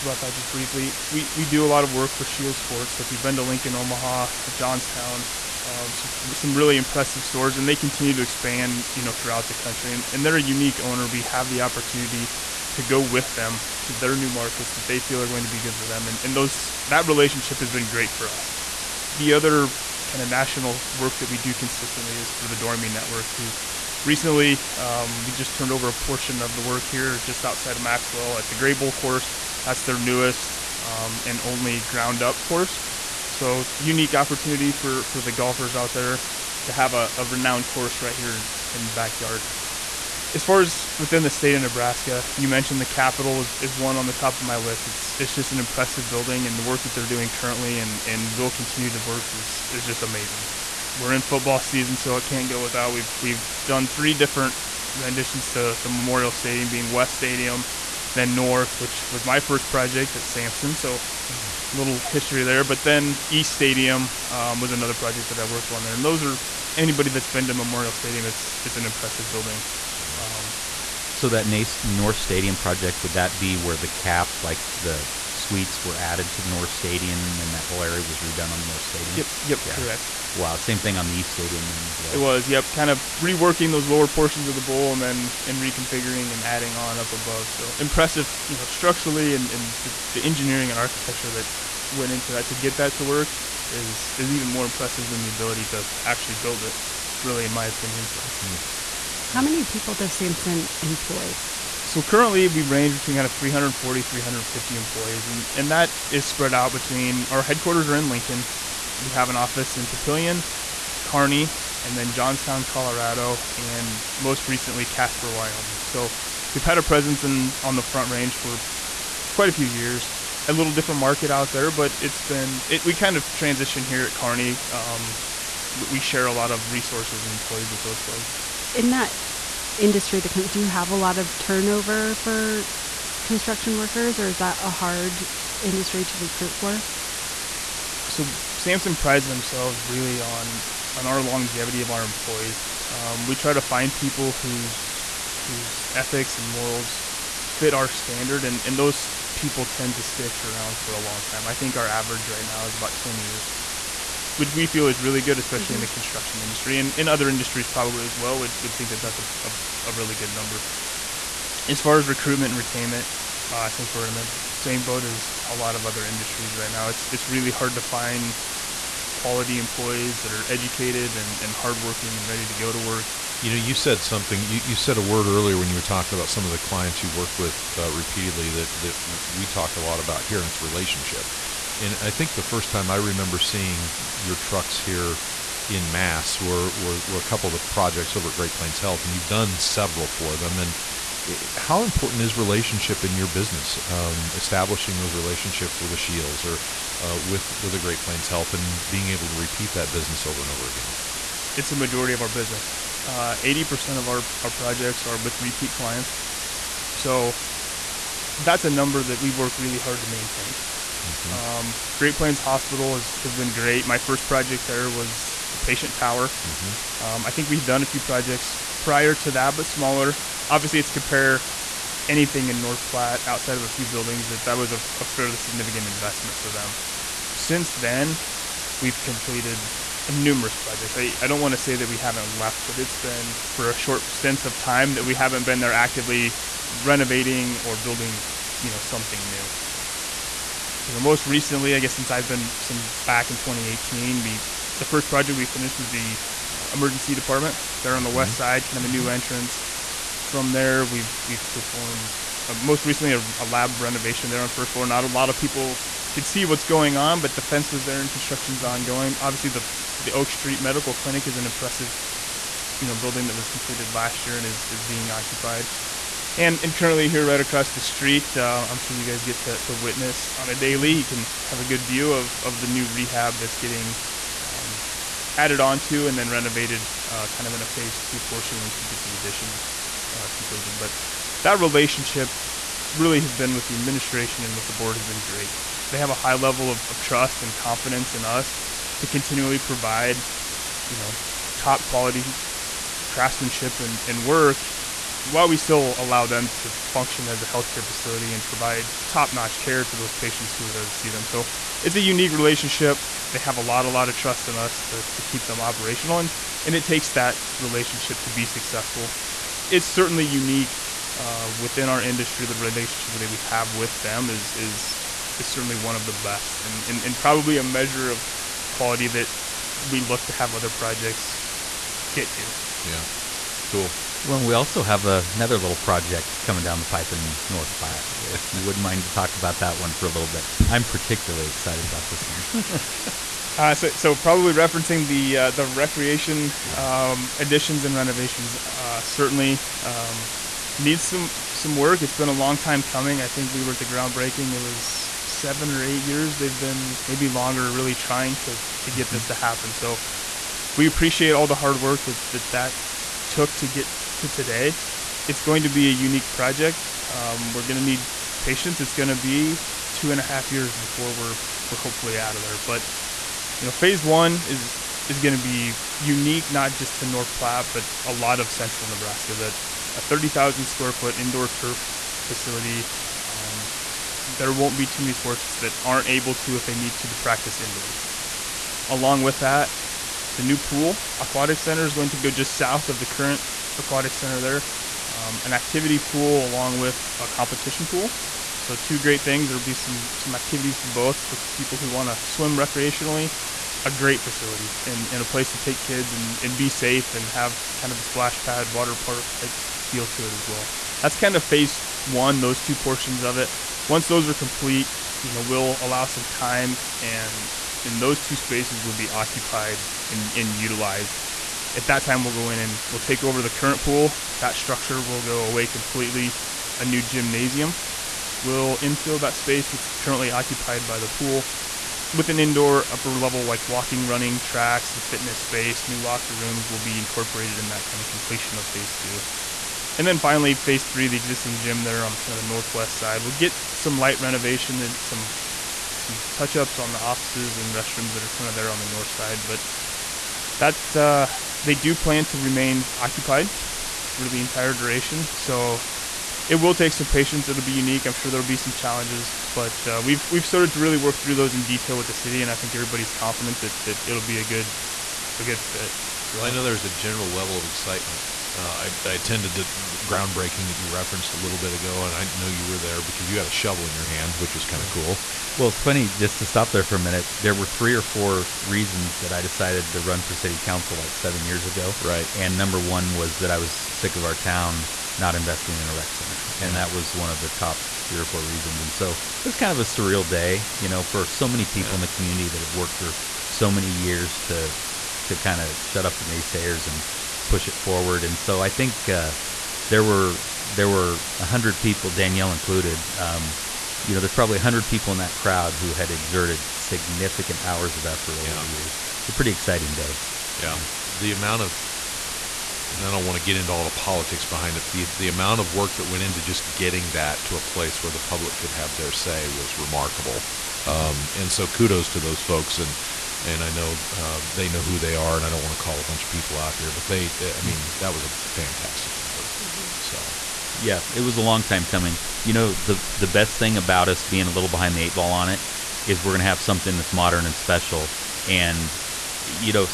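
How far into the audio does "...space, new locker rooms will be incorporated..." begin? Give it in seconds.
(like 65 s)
425 s.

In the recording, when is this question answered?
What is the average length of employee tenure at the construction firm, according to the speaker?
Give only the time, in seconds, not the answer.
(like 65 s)
152 s.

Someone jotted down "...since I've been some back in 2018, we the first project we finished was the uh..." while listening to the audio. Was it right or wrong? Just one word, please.
right.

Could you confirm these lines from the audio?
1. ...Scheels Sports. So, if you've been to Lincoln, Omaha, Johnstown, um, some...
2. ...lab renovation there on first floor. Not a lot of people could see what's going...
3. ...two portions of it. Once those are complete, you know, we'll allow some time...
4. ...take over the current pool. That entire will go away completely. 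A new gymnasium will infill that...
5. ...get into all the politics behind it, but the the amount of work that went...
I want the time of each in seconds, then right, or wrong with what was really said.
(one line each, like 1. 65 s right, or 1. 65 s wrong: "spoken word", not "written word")
1. 2 s right
2. 253 s right
3. 402 s right
4. 413 s wrong: "structure", not "entire"
5. 503 s right.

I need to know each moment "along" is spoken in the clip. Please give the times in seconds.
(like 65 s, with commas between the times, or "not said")
378 s, 386 s.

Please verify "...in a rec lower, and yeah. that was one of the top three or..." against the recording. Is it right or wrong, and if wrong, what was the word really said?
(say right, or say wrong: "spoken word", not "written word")
wrong: "center", not "lower".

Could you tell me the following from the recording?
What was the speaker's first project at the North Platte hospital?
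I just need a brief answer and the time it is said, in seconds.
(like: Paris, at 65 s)
the patient tower, at 215 s.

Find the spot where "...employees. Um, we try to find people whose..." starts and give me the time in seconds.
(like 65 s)
142 s.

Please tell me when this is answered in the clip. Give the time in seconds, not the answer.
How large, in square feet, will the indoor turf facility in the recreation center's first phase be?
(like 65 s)
370 s.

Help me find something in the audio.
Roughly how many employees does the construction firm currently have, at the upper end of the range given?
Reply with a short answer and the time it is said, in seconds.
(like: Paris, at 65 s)
350, at 104 s.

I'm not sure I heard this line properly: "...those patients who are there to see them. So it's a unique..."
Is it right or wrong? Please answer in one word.
right.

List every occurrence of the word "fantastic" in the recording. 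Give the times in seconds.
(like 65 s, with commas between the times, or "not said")
518 s.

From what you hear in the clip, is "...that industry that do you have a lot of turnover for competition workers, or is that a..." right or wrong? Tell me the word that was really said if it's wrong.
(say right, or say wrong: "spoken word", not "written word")
wrong: "construction", not "competition".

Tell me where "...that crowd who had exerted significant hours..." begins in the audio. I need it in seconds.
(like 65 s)
495 s.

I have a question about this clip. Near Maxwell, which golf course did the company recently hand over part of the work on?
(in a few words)
Gray Bowl.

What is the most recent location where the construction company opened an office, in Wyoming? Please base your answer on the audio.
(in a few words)
Casper.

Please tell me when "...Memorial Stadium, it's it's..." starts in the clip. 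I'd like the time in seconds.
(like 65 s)
67 s.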